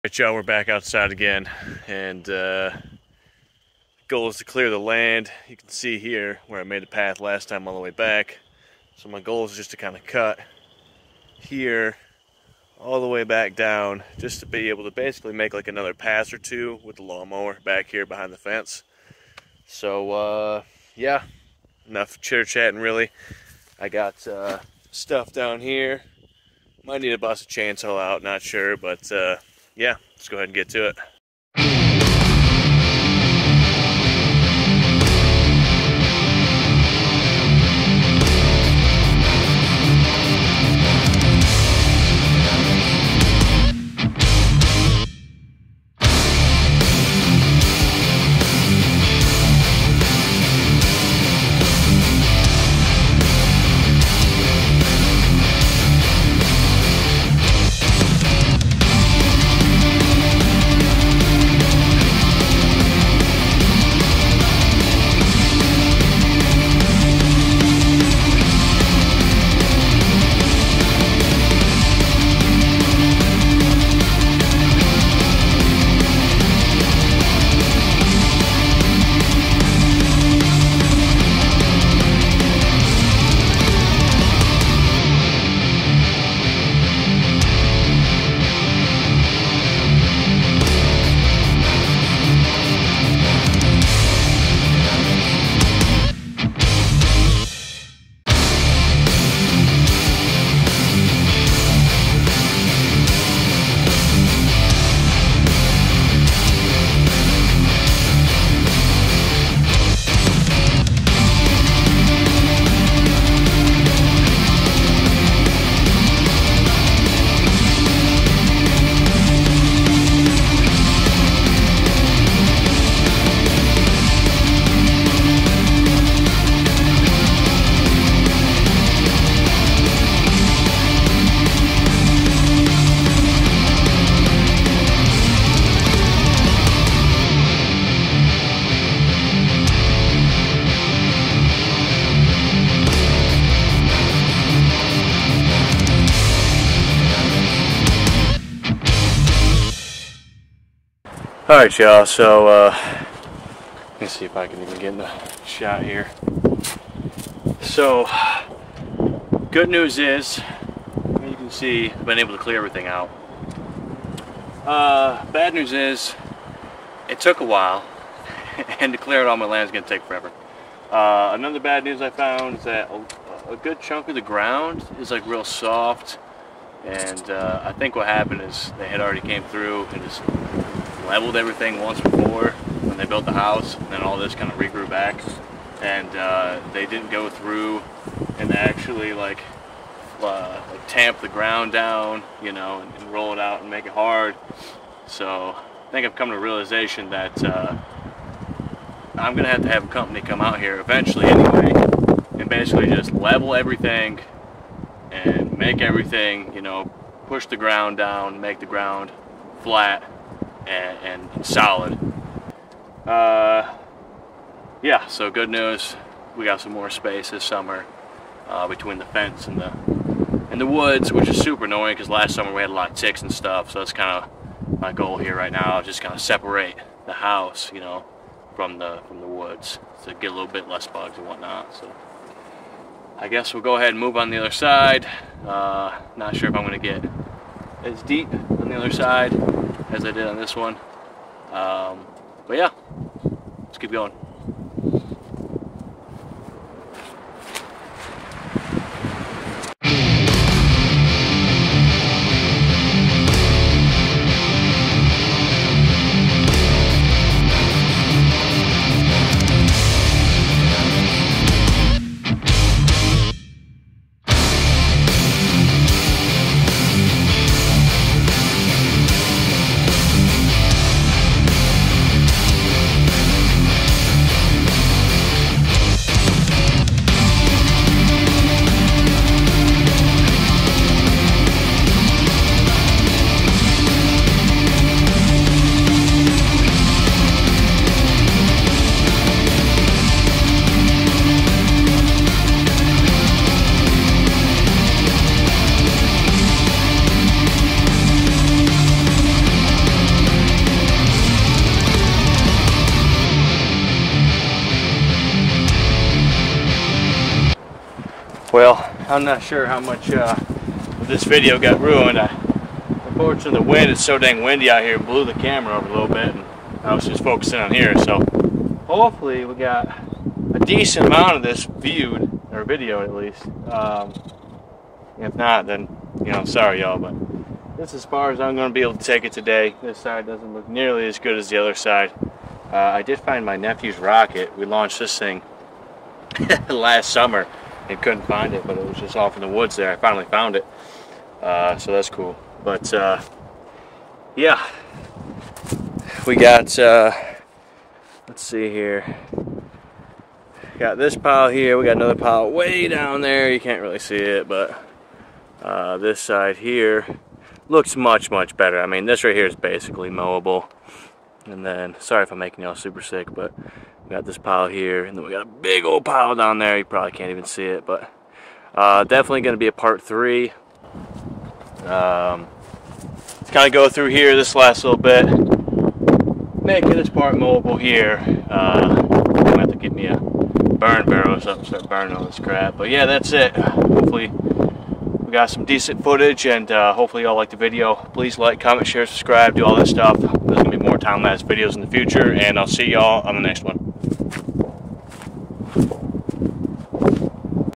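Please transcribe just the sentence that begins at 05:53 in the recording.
You can't really see it, but uh, this side here looks much, much better.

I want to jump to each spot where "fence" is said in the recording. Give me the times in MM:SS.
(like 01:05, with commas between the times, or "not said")
00:18, 03:39.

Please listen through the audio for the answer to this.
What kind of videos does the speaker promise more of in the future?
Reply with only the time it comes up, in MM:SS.
06:30.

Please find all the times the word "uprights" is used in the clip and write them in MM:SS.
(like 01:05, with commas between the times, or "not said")
not said.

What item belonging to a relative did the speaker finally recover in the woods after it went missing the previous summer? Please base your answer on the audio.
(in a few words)
Rocket.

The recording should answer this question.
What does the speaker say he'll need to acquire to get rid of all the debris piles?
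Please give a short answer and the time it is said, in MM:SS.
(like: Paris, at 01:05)
Burn barrel, at 06:20.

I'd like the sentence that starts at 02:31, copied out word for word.
Alright y'all, so uh, let me see if I can even get in the shot here.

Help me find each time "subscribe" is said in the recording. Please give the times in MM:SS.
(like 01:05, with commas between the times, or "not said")
06:29.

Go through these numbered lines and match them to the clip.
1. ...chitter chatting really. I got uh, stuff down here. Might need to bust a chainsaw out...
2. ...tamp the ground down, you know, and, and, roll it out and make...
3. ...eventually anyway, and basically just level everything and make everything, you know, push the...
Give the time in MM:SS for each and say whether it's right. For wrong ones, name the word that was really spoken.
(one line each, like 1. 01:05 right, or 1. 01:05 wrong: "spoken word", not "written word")
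1. 00:22 right
2. 03:10 right
3. 03:20 right.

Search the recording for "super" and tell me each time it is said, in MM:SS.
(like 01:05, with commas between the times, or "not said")
03:41, 06:02.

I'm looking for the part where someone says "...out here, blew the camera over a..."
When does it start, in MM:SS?
05:14.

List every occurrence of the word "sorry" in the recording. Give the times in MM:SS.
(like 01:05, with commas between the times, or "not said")
05:26, 06:01.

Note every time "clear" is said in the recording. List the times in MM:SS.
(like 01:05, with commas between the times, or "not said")
00:04, 02:42, 02:48.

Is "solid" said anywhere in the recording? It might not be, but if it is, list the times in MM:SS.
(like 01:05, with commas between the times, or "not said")
03:31.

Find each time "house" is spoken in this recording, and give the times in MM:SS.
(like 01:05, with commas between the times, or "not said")
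03:03, 03:47.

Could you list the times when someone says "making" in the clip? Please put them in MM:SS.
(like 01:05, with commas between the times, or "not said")
06:02, 06:16.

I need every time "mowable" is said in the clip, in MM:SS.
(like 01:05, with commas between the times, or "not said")
06:00.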